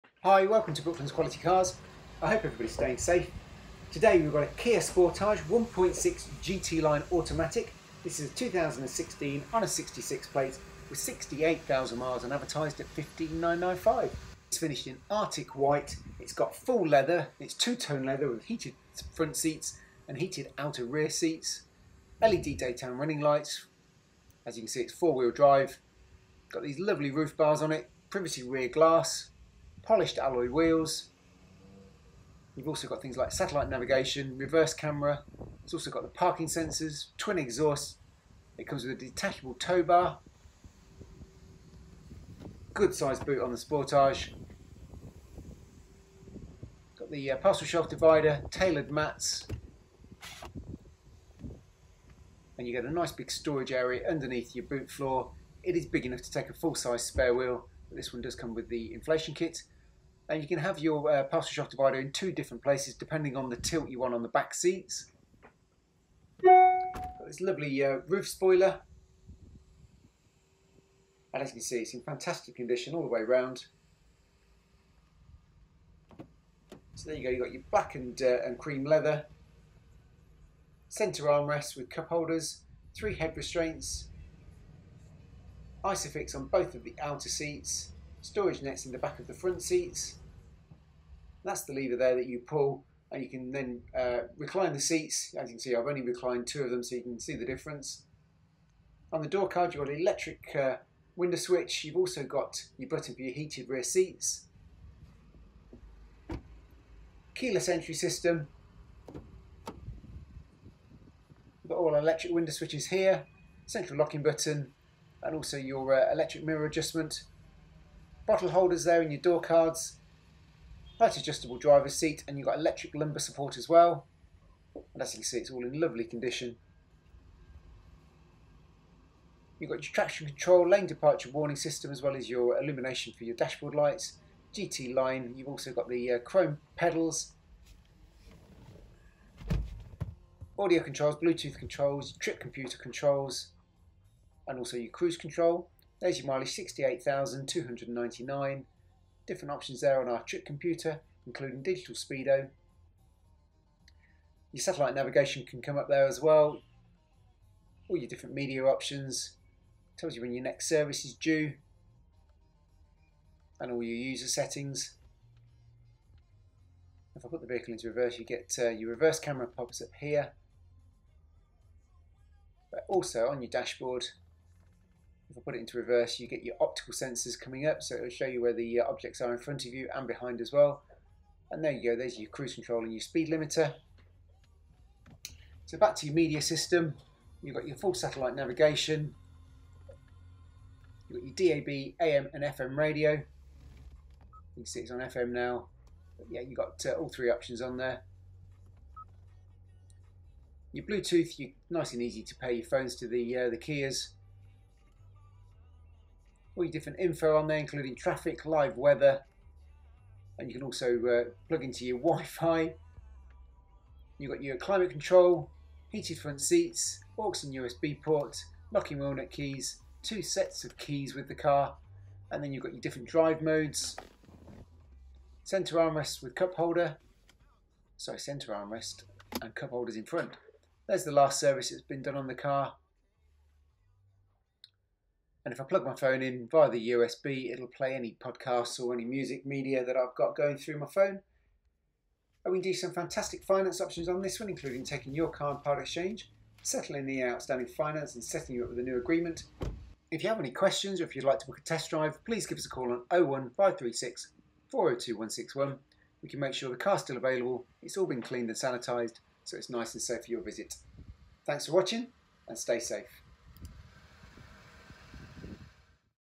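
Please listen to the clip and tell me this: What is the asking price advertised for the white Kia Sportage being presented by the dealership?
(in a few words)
15995.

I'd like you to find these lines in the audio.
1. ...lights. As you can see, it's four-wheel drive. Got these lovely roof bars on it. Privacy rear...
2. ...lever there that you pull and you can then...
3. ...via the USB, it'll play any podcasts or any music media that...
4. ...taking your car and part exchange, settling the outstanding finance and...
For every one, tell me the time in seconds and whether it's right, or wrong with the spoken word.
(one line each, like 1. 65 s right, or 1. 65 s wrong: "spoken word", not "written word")
1. 23 s right
2. 91 s right
3. 236 s right
4. 244 s right.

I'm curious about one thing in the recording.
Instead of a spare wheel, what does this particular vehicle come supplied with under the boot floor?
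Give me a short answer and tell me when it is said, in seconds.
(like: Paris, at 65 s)
inflation kit, at 58 s.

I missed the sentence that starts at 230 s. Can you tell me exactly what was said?
There's the last service that's been done on the car.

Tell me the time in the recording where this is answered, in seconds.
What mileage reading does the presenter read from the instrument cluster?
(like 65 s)
146 s.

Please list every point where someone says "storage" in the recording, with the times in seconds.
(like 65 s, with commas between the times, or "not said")
53 s, 88 s.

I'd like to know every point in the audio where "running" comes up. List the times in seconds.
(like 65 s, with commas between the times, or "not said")
23 s.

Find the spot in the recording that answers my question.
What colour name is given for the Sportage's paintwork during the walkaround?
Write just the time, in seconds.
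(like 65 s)
15 s.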